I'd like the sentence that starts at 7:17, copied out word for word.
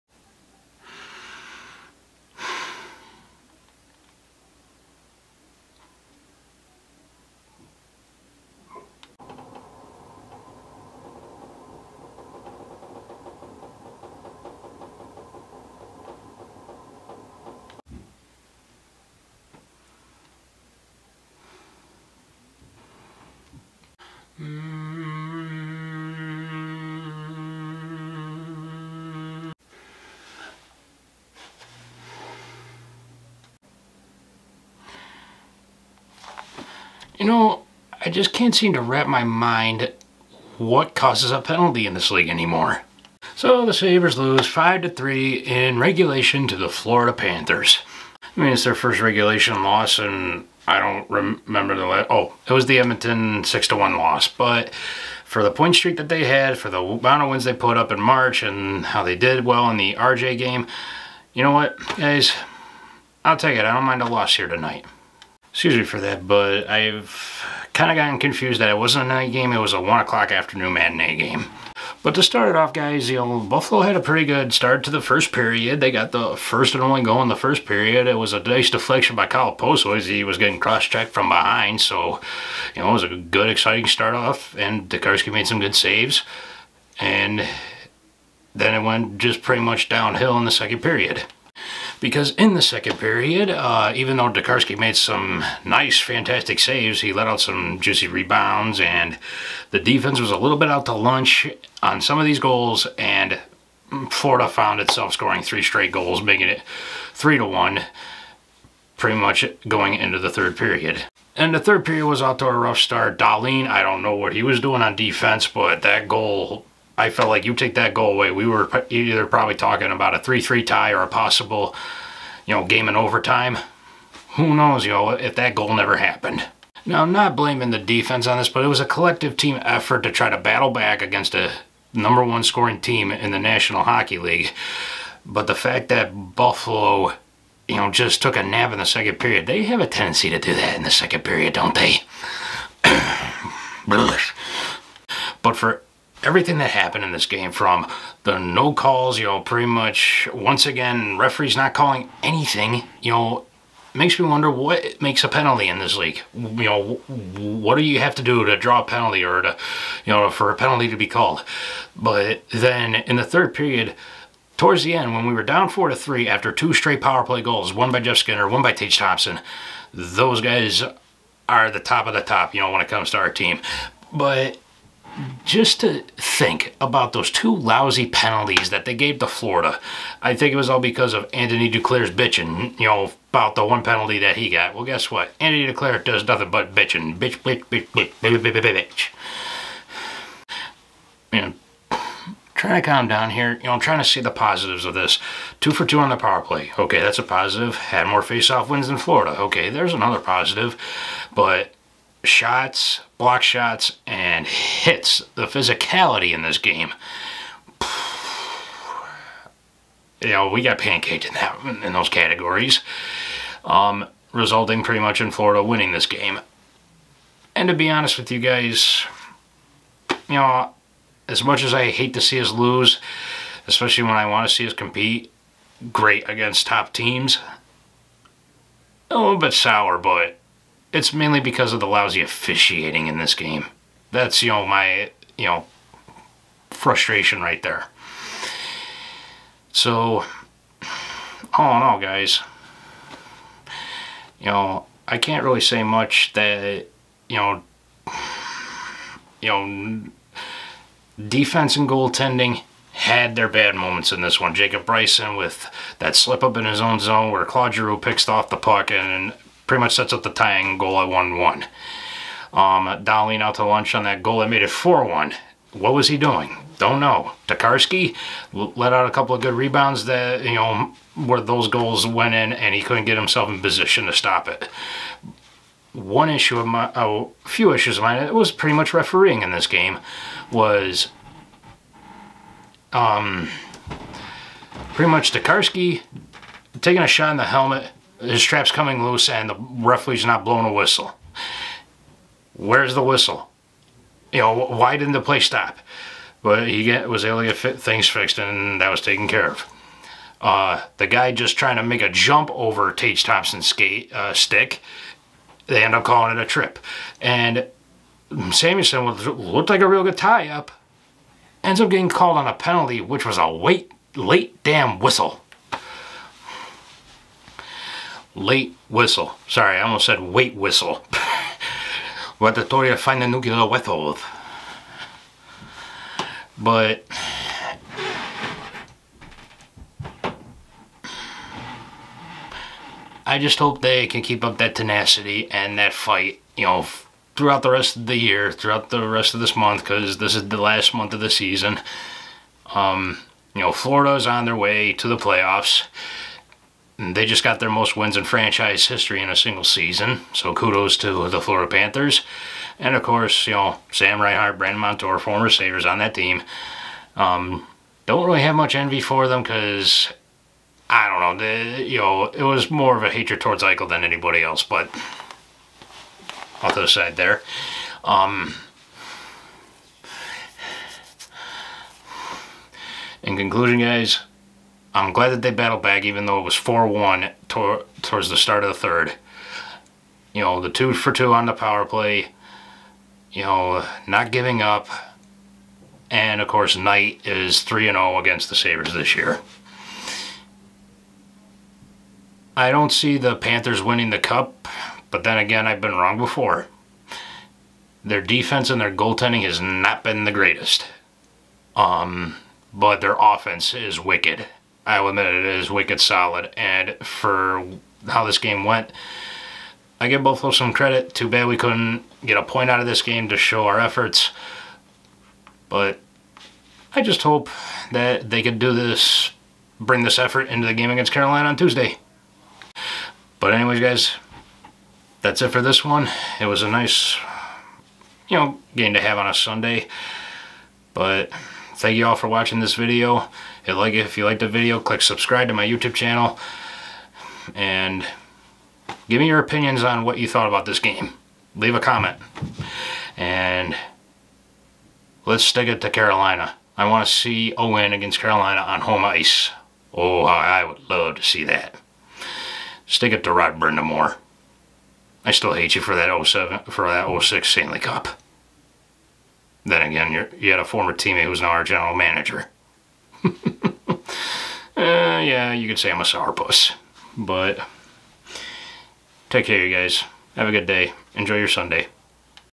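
And give me your opinions on what you thought about this game.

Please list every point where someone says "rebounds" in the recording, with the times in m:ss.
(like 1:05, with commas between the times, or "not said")
1:38, 4:29.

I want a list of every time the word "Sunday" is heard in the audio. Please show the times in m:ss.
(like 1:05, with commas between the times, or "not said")
7:09, 7:51.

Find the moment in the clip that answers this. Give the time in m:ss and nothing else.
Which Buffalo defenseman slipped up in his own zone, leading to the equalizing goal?
4:14.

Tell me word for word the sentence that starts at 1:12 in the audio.
But to start it off, guys, you know, Buffalo had a pretty good start to the first period.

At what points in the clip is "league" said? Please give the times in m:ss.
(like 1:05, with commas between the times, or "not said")
0:42, 2:14, 2:35.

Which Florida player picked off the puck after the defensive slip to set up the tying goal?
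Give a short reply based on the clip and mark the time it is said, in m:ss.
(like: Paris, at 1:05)
Claude Giroux, at 4:17.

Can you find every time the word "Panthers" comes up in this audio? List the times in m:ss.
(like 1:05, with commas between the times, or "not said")
0:47, 5:51, 6:33.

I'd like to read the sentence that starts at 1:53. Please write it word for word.
Dahlin, I don't know what he was doing on defense, but that goal I felt like you take that goal away.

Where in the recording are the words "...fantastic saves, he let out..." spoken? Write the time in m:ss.
1:36.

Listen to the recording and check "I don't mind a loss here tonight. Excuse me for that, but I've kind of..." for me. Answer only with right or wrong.
right.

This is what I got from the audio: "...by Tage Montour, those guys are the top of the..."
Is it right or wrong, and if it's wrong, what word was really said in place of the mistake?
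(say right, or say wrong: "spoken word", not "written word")
wrong: "Thompson", not "Montour".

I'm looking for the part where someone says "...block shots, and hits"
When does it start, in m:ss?
3:23.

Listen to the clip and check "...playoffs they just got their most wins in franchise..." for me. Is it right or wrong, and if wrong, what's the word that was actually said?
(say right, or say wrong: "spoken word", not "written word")
right.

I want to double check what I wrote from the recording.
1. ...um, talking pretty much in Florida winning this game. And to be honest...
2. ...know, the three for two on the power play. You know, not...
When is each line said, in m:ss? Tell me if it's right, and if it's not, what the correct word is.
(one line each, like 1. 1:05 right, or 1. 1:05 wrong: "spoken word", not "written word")
1. 3:33 wrong: "resulting", not "talking"
2. 6:20 wrong: "two", not "three".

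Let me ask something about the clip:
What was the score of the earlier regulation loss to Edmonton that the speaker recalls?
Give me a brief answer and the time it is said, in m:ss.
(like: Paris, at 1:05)
6 to 1, at 0:53.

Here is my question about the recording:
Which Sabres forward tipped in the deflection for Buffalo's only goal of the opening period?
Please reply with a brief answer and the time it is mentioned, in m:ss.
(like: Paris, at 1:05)
Kyle Okposo, at 1:19.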